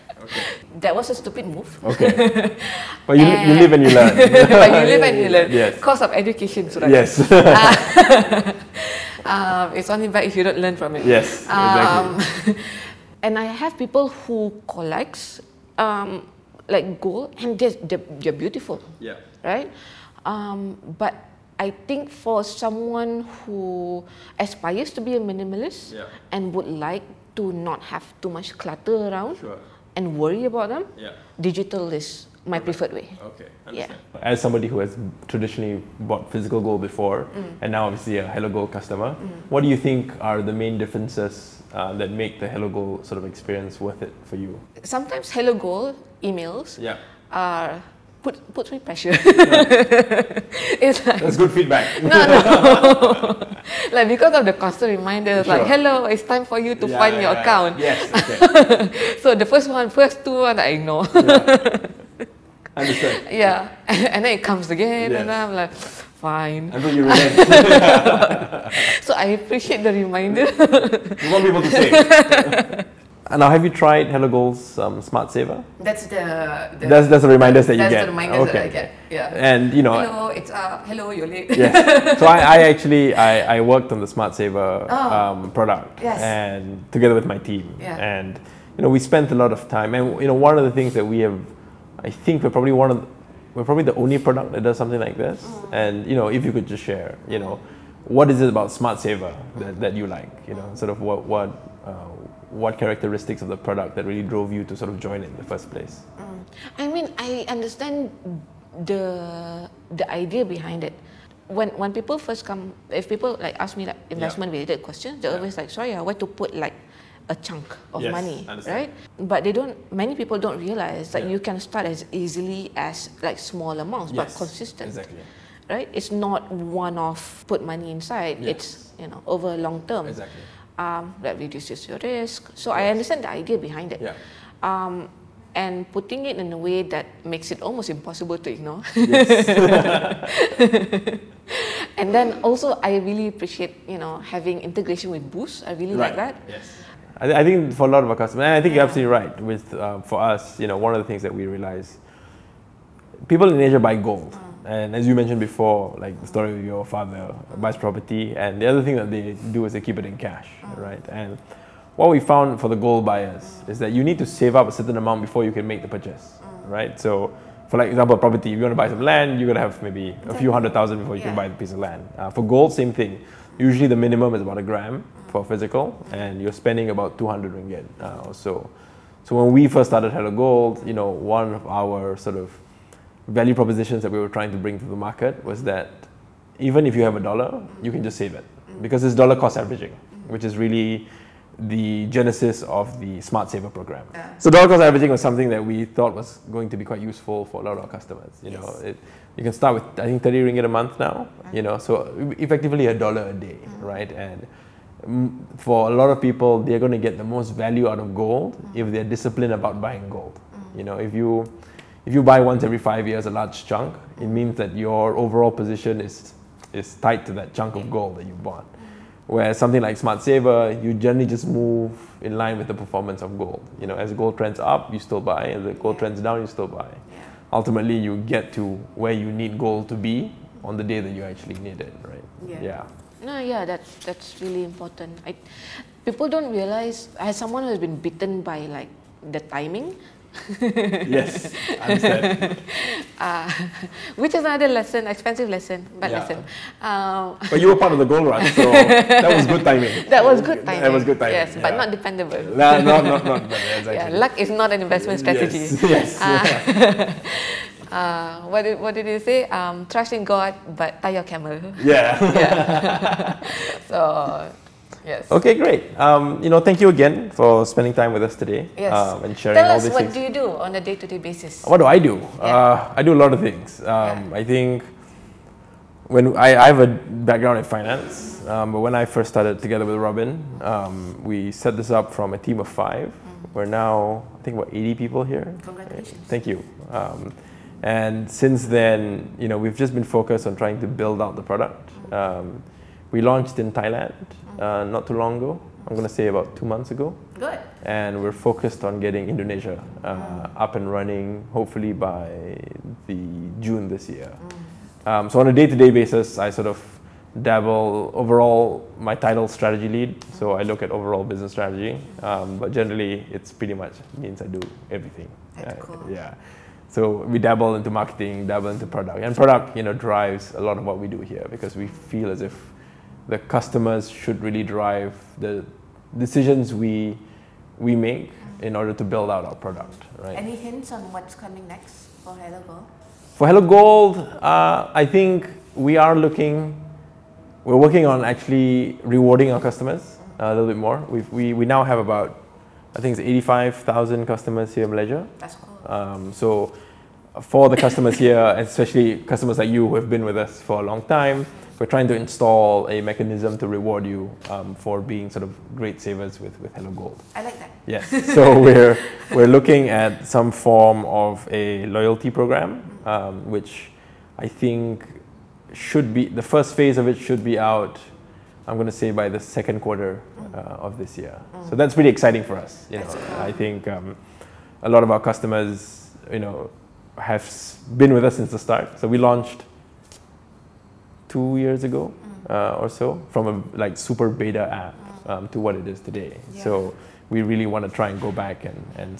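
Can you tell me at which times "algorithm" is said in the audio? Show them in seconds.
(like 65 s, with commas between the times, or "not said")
not said.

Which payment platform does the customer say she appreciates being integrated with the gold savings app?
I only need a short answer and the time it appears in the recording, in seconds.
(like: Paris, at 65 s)
Boost, at 145 s.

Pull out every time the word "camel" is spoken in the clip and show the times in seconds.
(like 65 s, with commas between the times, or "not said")
261 s.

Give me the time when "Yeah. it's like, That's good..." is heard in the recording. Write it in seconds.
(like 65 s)
49 s.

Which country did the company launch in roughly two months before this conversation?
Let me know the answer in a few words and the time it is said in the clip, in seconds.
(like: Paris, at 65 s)
Thailand, at 293 s.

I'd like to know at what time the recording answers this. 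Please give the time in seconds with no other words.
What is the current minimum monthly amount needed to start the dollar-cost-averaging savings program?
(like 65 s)
200 s.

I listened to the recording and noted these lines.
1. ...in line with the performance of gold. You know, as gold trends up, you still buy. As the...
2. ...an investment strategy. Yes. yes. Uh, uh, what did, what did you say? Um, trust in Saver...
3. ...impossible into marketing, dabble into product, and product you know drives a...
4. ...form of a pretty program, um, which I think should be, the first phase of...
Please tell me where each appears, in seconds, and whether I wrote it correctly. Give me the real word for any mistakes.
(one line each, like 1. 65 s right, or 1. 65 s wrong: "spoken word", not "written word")
1. 222 s right
2. 254 s wrong: "God", not "Saver"
3. 317 s wrong: "dabble", not "impossible"
4. 360 s wrong: "loyalty", not "pretty".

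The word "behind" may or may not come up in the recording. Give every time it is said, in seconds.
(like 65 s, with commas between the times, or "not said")
110 s, 133 s.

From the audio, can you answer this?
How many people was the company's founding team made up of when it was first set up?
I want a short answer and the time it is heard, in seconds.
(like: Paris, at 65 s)
5, at 282 s.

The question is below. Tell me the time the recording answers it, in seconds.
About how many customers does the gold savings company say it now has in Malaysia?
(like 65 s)
343 s.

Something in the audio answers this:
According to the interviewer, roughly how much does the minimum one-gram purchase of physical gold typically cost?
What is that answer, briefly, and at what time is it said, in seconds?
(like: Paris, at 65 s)
200 ringgit, at 177 s.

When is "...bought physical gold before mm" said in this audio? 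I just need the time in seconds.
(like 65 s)
36 s.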